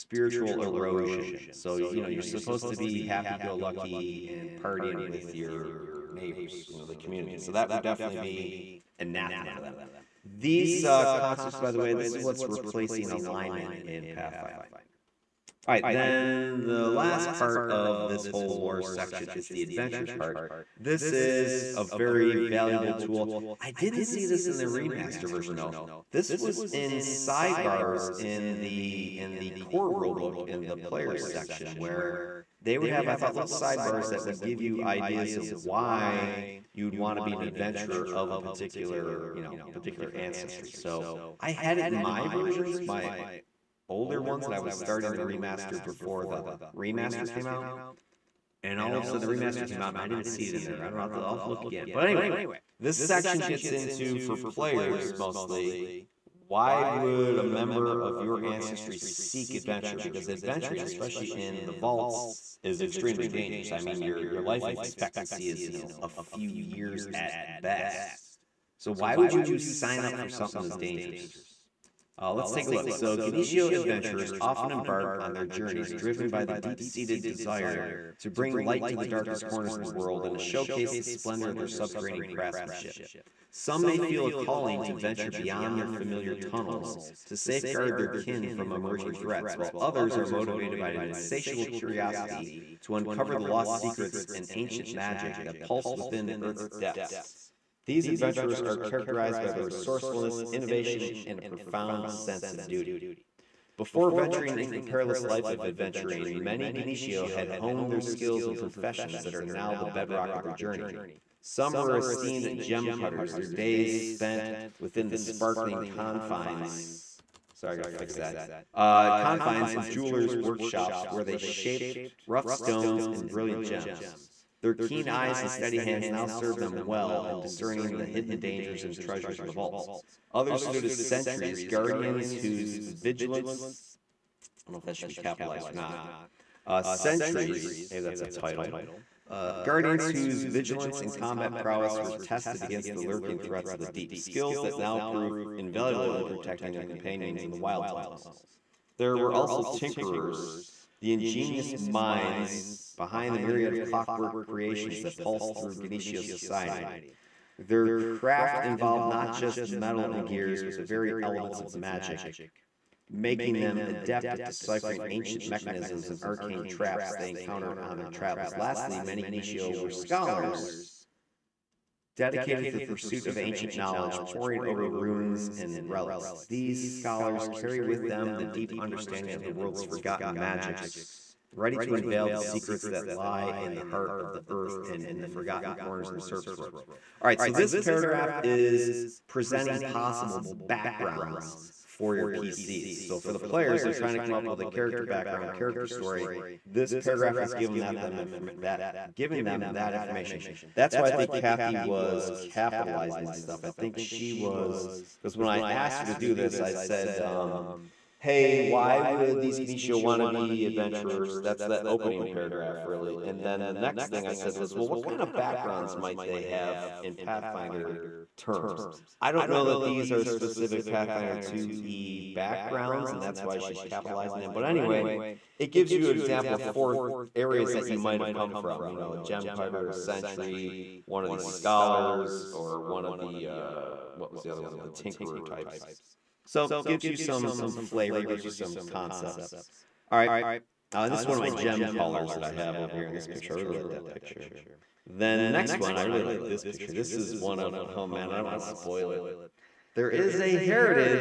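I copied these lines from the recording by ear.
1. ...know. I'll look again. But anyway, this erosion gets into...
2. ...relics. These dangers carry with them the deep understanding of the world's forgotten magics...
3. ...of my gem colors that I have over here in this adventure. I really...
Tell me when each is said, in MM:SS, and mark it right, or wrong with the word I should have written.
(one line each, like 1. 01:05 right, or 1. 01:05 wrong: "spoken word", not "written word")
1. 00:51 wrong: "section", not "erosion"
2. 02:55 wrong: "scholars", not "dangers"
3. 04:01 wrong: "picture", not "adventure".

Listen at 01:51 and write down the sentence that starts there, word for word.
Some were esteemed gem cutters, their days spent within the sparkling confines.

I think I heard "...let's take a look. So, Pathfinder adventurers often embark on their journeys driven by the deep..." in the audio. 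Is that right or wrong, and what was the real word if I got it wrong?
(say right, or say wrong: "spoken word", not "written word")
wrong: "Gnishiho", not "Pathfinder".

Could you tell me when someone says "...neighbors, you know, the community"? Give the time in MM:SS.
00:06.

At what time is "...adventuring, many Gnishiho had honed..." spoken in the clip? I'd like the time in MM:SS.
01:45.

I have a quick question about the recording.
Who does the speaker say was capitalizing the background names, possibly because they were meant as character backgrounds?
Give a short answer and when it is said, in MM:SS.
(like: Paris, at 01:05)
Cathy, at 03:21.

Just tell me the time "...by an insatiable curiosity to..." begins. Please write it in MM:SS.
01:30.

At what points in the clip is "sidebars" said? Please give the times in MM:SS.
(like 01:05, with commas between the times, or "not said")
00:26, 00:33.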